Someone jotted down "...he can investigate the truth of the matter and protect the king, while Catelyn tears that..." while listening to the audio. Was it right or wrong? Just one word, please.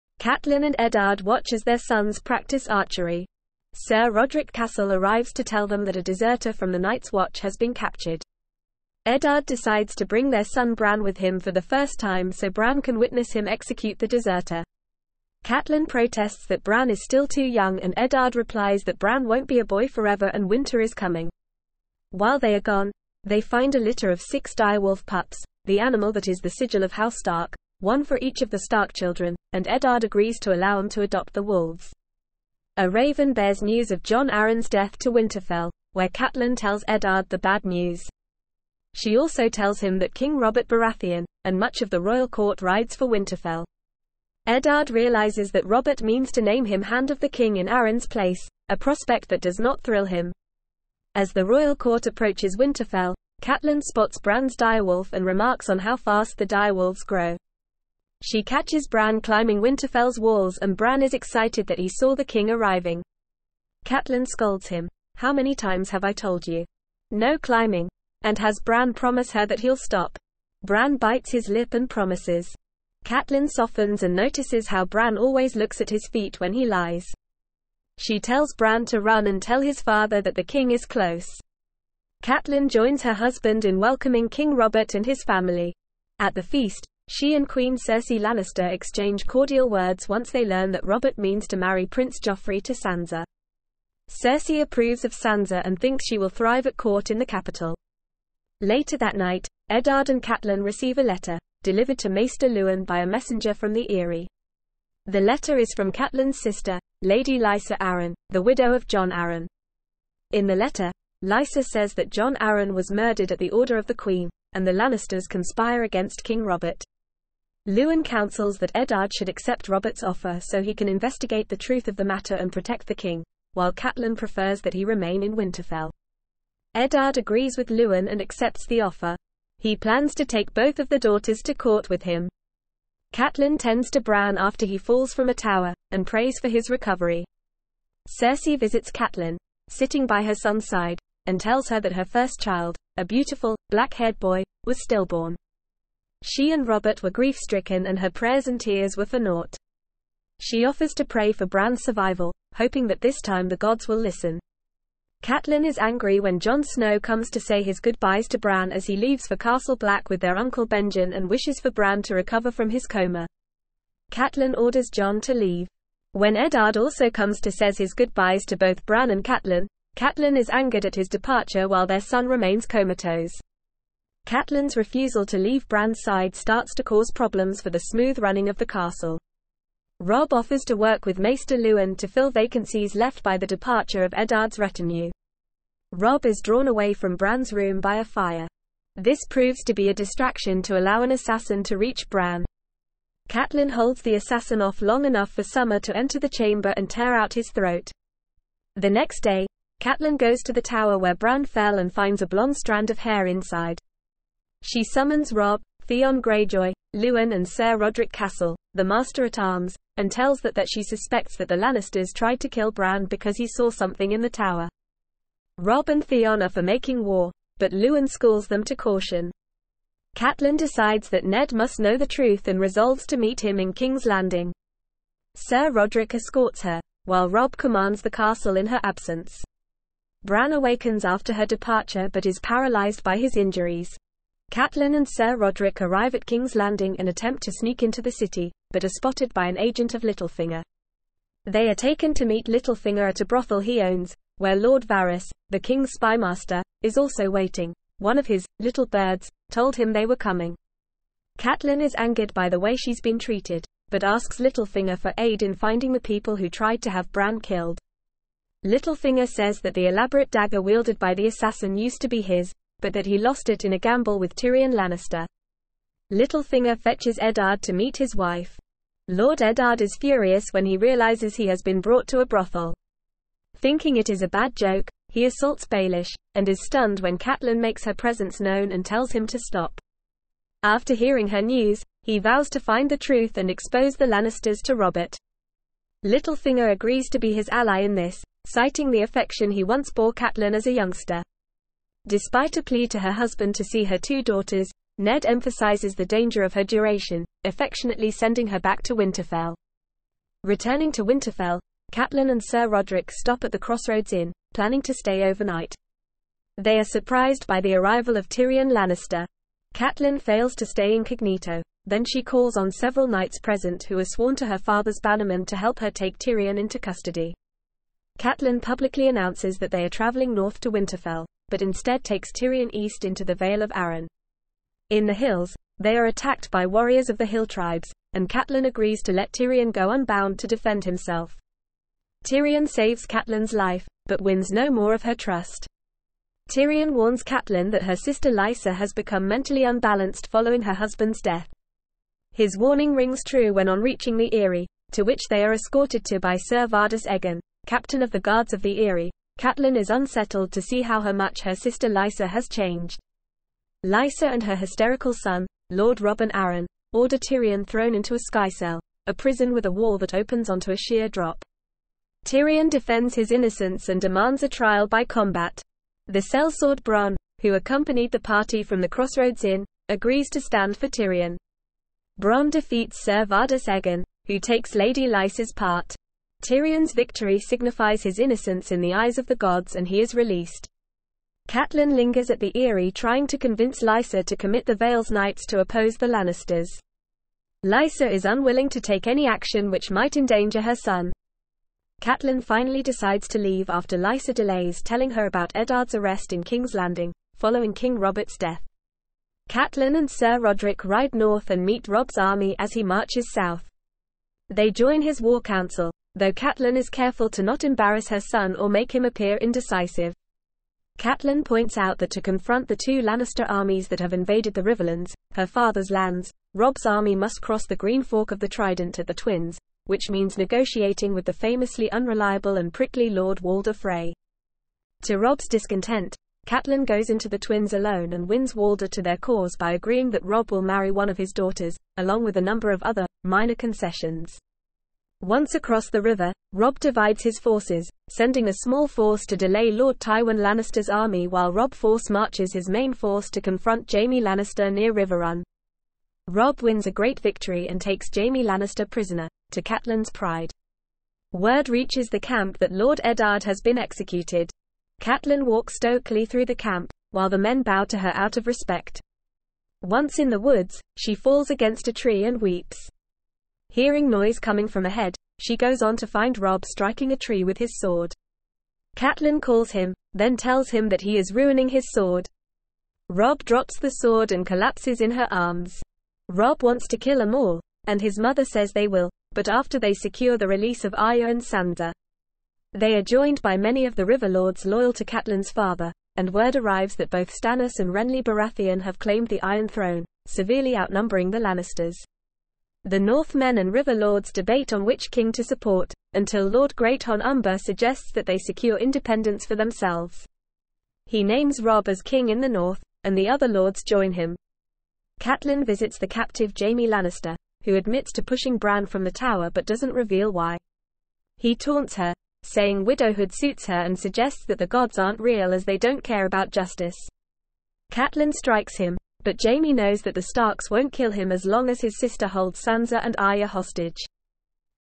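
wrong.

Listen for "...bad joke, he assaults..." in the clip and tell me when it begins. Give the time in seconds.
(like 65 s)
274 s.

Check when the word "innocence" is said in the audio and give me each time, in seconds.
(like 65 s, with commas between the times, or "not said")
363 s, 378 s.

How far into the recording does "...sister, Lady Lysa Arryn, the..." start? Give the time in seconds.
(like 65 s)
106 s.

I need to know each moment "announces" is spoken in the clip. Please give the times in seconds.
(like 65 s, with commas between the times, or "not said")
319 s.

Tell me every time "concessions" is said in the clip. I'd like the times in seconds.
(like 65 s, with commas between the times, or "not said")
433 s.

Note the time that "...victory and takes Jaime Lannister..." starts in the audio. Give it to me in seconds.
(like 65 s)
447 s.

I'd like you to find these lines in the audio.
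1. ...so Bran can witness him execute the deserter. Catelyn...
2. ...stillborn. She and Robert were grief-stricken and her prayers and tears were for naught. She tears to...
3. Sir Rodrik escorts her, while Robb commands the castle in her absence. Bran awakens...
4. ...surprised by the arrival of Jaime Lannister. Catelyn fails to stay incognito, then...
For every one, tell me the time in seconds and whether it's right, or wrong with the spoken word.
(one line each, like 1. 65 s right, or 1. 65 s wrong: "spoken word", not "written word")
1. 12 s right
2. 144 s wrong: "offers", not "tears"
3. 225 s right
4. 306 s wrong: "Tyrion", not "Jaime".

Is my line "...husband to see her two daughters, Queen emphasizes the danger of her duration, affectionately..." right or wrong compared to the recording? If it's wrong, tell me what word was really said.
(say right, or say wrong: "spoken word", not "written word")
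wrong: "Ned", not "Queen".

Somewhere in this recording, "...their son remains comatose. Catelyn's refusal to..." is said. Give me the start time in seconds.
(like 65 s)
171 s.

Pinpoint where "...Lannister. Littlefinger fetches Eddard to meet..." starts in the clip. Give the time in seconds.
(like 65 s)
264 s.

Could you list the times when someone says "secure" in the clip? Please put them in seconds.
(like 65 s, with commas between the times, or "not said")
479 s, 498 s.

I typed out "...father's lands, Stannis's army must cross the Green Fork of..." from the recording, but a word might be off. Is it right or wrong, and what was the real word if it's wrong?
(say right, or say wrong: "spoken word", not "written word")
wrong: "Robb", not "Stannis".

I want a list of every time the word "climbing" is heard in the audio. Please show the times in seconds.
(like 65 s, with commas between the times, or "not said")
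59 s, 67 s.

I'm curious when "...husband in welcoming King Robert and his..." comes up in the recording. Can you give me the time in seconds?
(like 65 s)
83 s.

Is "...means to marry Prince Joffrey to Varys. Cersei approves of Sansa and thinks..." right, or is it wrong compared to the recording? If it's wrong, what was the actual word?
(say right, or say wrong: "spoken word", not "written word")
wrong: "Sansa", not "Varys".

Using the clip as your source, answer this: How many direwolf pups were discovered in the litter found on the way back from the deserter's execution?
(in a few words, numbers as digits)
6.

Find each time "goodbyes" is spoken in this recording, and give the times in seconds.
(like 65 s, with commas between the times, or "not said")
157 s, 167 s.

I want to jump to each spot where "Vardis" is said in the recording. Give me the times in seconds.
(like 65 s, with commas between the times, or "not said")
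346 s, 373 s.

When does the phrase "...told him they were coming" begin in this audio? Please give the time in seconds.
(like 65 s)
249 s.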